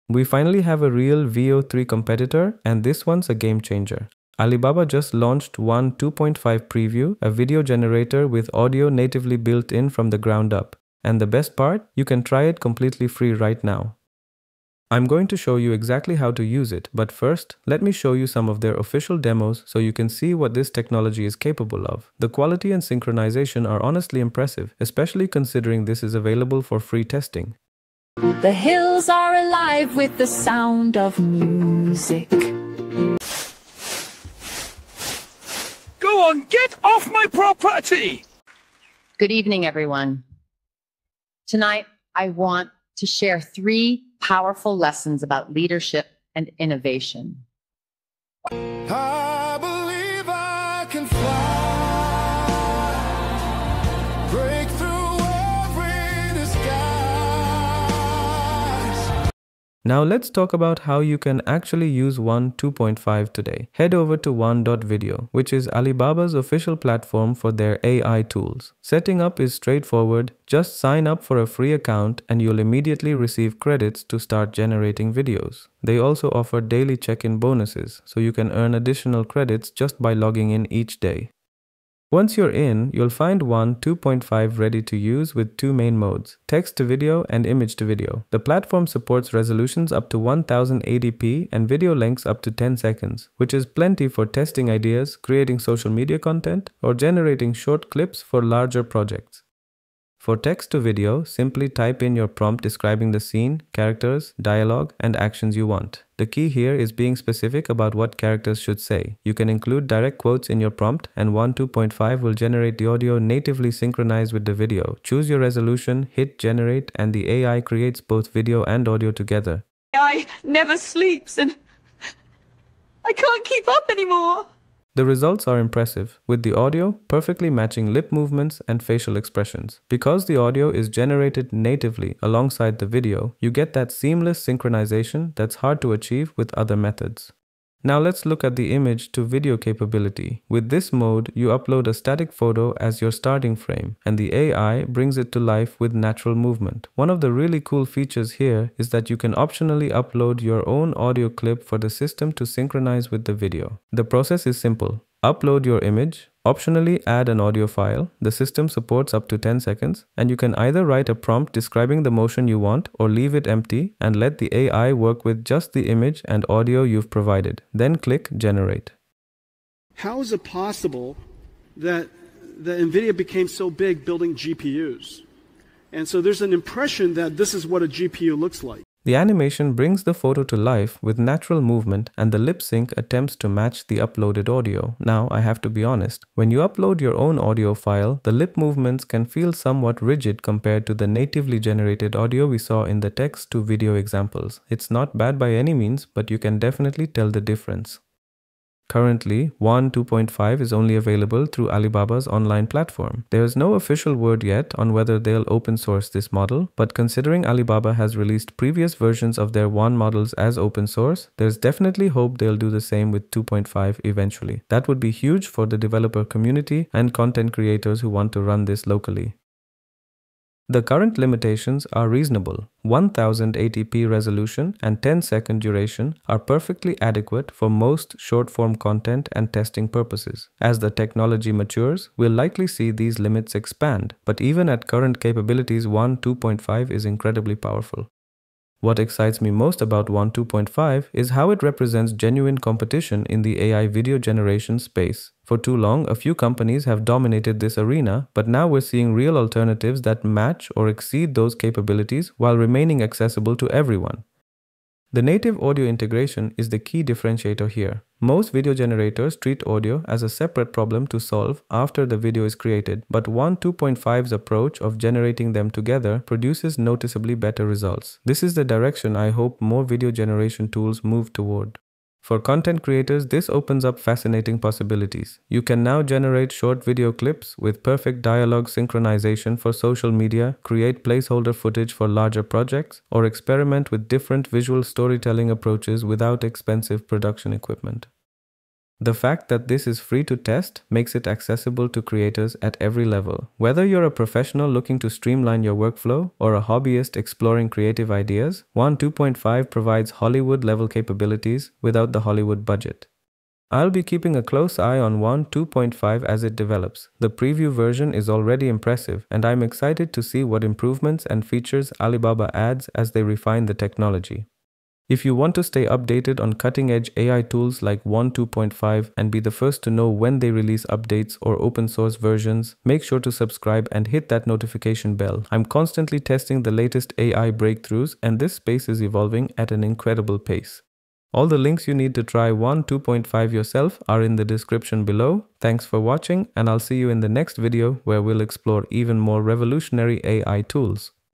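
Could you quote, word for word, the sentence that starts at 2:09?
Because the audio is generated natively alongside the video, you get that seamless synchronization that's hard to achieve with other methods.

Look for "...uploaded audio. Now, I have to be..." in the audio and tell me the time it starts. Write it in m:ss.
3:03.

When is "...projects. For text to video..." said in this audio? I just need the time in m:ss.
1:38.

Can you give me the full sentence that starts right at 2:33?
The process is simple upload your image, optionally add an audio file.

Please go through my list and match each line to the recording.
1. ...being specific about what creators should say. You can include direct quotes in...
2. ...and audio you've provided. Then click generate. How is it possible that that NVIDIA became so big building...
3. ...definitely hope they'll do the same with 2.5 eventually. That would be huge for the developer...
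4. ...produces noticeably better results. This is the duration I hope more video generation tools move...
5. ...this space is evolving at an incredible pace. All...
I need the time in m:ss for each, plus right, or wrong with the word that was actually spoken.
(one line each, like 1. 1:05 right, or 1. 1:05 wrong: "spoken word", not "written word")
1. 1:46 wrong: "characters", not "creators"
2. 2:46 right
3. 3:31 right
4. 4:26 wrong: "direction", not "duration"
5. 5:28 right.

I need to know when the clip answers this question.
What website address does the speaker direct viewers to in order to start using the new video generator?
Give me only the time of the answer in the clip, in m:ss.
1:04.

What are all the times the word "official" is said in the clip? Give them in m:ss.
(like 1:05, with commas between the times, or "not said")
0:18, 1:06, 3:23.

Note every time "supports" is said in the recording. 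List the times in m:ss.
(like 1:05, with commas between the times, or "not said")
1:28, 2:38.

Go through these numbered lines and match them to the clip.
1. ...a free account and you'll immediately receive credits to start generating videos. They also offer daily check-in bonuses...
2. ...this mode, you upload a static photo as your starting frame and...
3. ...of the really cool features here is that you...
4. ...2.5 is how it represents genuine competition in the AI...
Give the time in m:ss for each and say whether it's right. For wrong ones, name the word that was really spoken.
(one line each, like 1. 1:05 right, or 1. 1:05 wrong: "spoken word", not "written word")
1. 1:11 right
2. 2:20 right
3. 2:27 right
4. 4:00 right.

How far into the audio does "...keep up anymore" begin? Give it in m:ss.
2:03.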